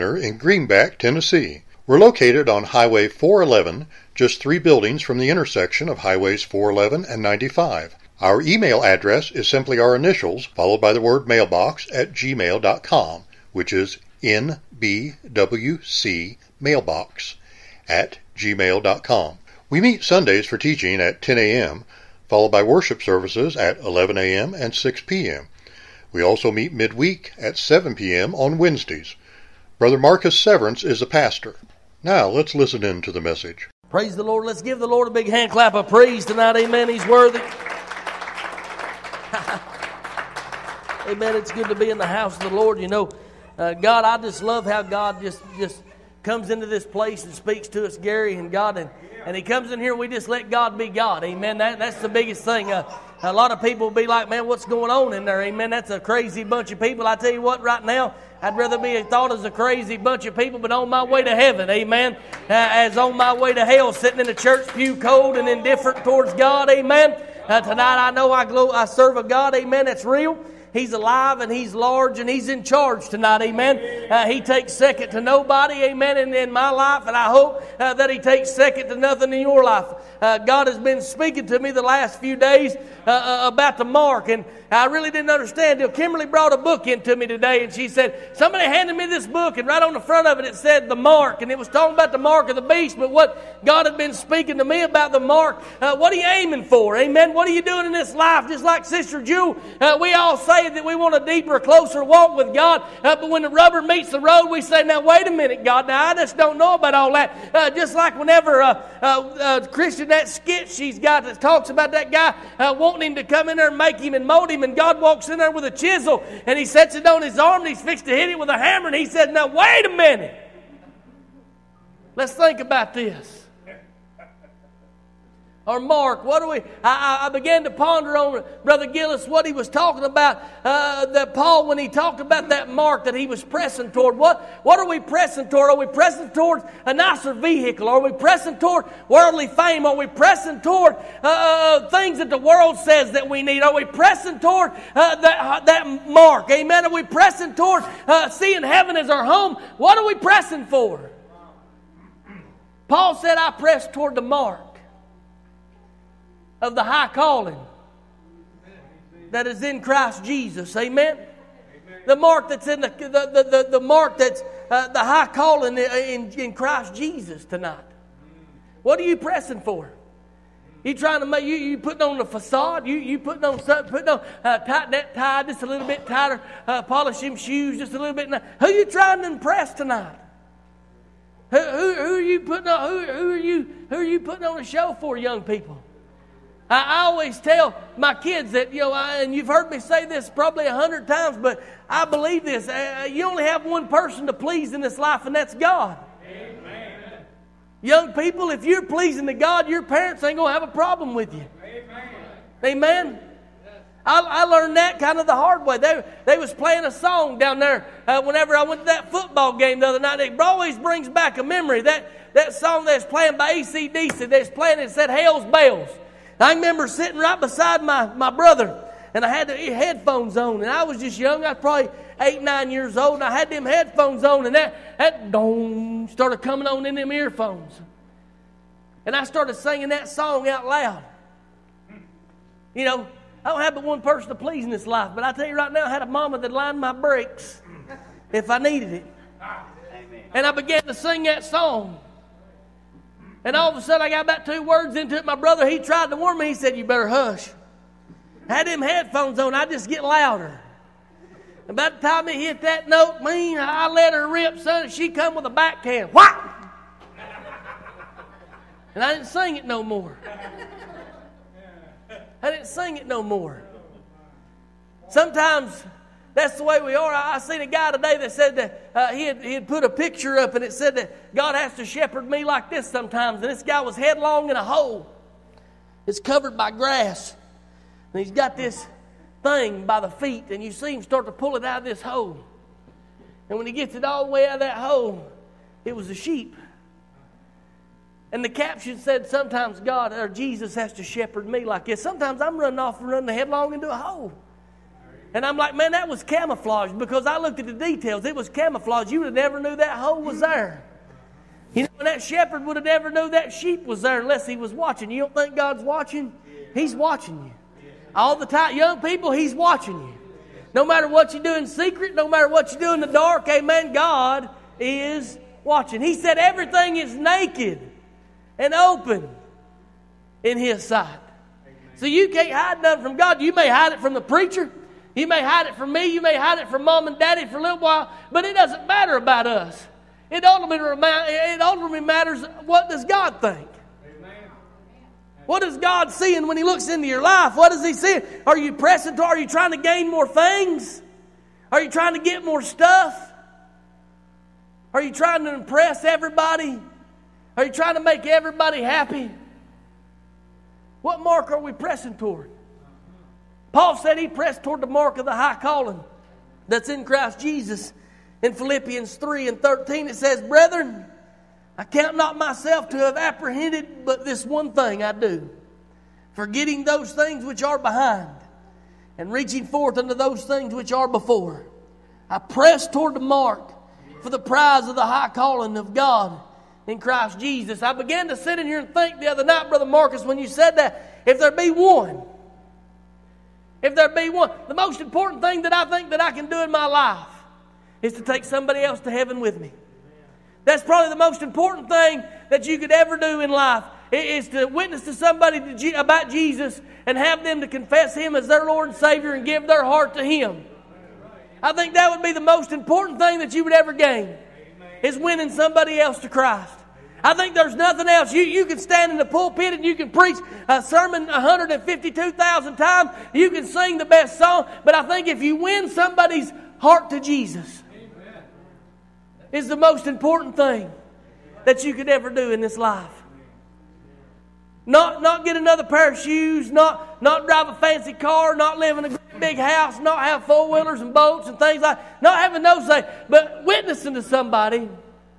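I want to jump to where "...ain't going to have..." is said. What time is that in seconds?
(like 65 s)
200 s.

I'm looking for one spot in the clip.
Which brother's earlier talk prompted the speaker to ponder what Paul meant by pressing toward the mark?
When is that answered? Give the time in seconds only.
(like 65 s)
128 s.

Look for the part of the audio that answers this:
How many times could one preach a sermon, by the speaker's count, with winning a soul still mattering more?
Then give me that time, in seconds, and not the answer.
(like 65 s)
411 s.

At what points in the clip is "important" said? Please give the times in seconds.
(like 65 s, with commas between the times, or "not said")
384 s, 391 s, 402 s, 420 s.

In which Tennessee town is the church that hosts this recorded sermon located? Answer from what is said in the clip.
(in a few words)
Greenback.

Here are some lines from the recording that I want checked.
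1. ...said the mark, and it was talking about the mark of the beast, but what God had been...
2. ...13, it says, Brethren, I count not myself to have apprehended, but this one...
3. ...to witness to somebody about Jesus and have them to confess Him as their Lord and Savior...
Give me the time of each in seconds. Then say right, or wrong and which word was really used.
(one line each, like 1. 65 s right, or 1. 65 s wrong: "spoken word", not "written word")
1. 90 s right
2. 359 s right
3. 394 s right.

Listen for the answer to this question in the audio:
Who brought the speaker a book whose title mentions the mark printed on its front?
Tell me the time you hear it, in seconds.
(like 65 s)
85 s.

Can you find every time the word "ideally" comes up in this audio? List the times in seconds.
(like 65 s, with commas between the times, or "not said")
not said.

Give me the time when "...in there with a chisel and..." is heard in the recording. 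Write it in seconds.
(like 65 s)
115 s.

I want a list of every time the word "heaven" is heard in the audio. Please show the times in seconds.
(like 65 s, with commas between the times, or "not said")
61 s, 148 s, 389 s.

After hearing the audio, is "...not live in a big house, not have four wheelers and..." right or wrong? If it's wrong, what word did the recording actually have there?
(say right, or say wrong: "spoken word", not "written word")
right.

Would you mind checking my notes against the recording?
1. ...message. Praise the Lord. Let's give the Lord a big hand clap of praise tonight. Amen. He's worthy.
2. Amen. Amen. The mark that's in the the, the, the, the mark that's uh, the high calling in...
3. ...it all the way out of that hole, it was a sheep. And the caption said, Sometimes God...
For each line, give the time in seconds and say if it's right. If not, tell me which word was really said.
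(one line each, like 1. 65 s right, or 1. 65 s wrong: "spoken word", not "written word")
1. 33 s right
2. 160 s right
3. 283 s right.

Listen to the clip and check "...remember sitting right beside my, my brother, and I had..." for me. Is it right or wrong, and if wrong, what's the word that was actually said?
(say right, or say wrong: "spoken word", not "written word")
right.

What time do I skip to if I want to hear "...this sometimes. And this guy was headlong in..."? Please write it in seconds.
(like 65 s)
272 s.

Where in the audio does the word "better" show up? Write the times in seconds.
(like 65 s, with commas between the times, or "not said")
246 s.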